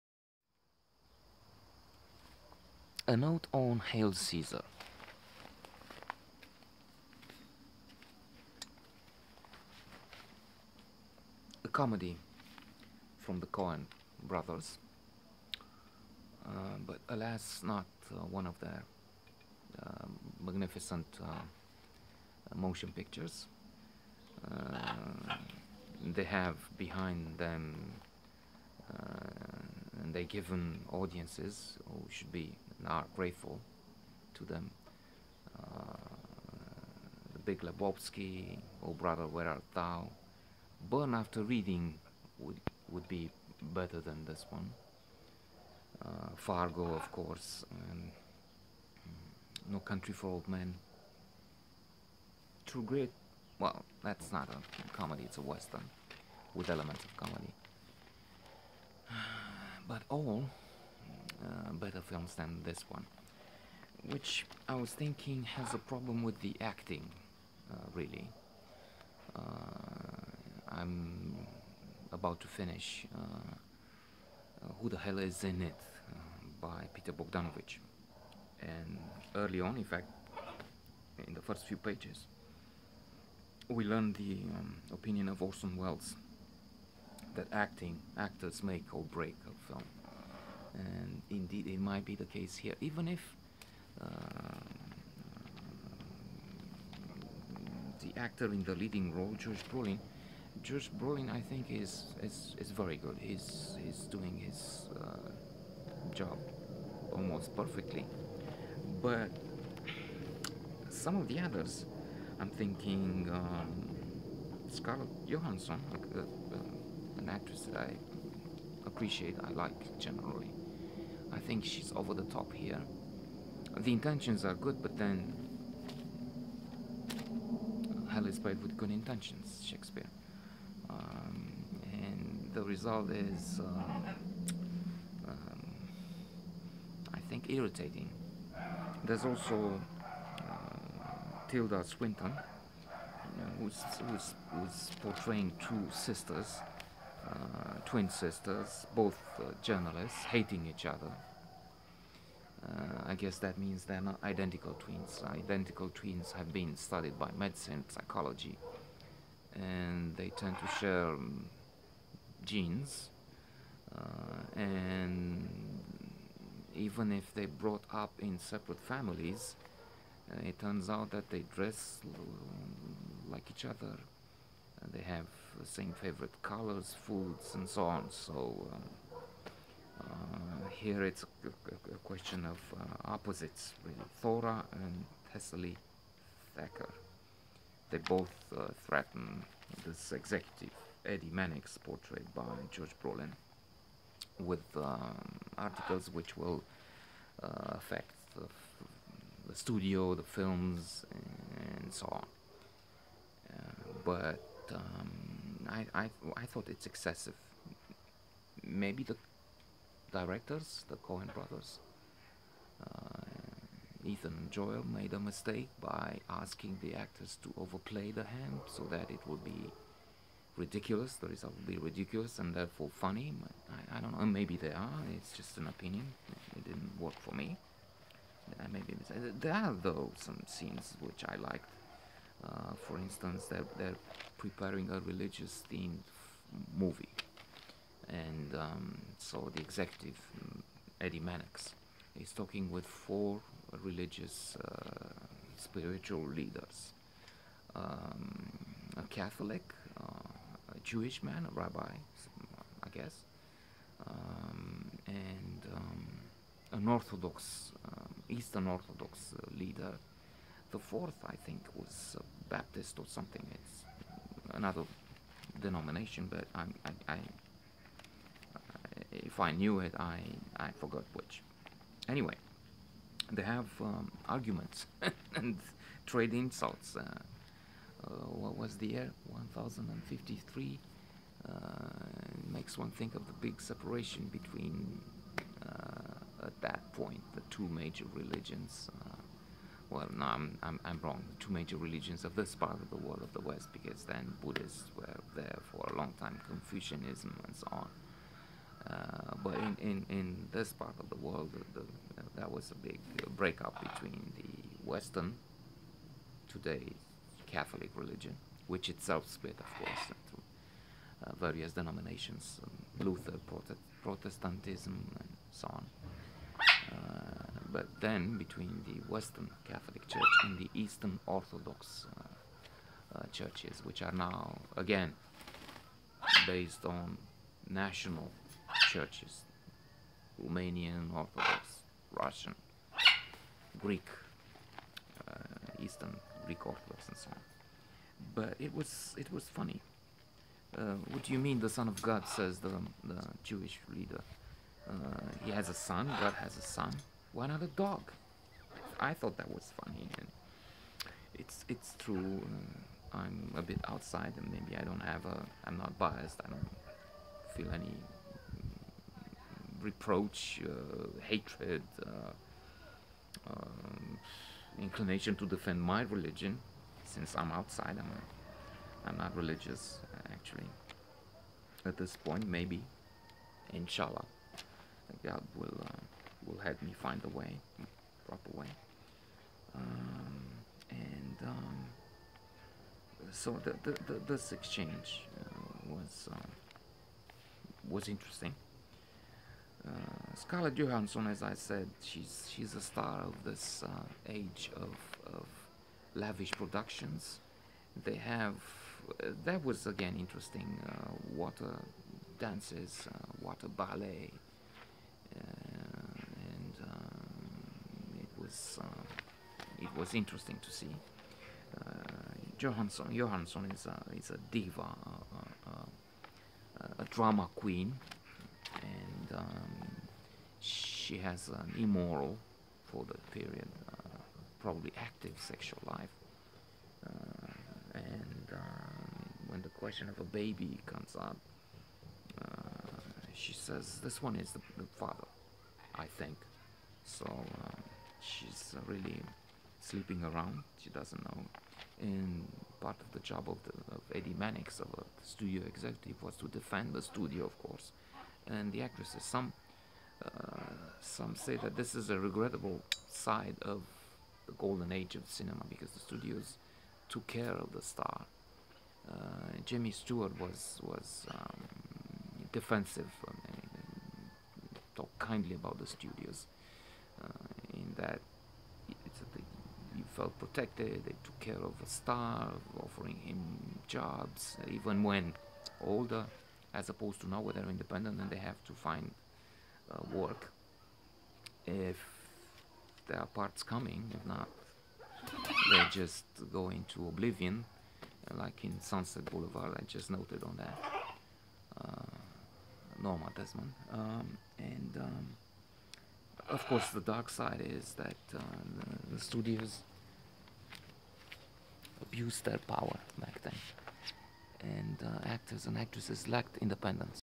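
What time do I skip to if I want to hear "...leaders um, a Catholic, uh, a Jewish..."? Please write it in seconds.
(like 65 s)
246 s.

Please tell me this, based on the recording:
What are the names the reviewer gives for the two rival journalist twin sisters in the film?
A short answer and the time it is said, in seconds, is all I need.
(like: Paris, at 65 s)
Thora and Thessaly Thacker, at 184 s.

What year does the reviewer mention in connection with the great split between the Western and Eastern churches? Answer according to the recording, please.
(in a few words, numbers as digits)
1053.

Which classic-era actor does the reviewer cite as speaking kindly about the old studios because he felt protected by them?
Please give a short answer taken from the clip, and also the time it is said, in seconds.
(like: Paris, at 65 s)
Jimmy Stewart, at 459 s.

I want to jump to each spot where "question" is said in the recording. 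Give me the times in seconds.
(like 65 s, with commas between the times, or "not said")
182 s, 429 s.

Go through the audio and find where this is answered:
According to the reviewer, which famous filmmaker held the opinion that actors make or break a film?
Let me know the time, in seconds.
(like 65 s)
85 s.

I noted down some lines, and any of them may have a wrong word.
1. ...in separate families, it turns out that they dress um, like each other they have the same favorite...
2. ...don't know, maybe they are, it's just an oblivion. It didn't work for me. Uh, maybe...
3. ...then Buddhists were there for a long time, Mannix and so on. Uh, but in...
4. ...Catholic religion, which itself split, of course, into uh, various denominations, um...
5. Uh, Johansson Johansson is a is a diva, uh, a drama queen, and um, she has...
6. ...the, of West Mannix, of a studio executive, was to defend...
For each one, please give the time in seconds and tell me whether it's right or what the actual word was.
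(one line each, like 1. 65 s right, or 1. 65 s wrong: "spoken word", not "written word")
1. 168 s right
2. 224 s wrong: "opinion", not "oblivion"
3. 294 s wrong: "Confucianism", not "Mannix"
4. 307 s right
5. 411 s right
6. 443 s wrong: "Eddie", not "West".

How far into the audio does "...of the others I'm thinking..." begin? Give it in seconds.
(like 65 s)
111 s.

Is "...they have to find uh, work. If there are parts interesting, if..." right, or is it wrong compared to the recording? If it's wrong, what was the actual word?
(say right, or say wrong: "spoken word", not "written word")
wrong: "coming", not "interesting".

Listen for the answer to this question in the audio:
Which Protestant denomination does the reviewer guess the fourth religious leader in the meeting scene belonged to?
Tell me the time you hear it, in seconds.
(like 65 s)
262 s.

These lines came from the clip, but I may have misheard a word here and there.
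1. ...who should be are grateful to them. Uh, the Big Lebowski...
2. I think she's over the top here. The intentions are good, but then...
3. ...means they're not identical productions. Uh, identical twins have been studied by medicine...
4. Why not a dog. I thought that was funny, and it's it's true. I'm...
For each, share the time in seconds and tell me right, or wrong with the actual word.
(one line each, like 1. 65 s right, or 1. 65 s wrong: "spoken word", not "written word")
1. 31 s right
2. 121 s right
3. 153 s wrong: "twins", not "productions"
4. 347 s right.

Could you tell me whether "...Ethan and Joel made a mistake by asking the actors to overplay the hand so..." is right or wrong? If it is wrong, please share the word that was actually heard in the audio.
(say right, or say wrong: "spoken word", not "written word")
right.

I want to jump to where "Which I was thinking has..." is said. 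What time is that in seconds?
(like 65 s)
64 s.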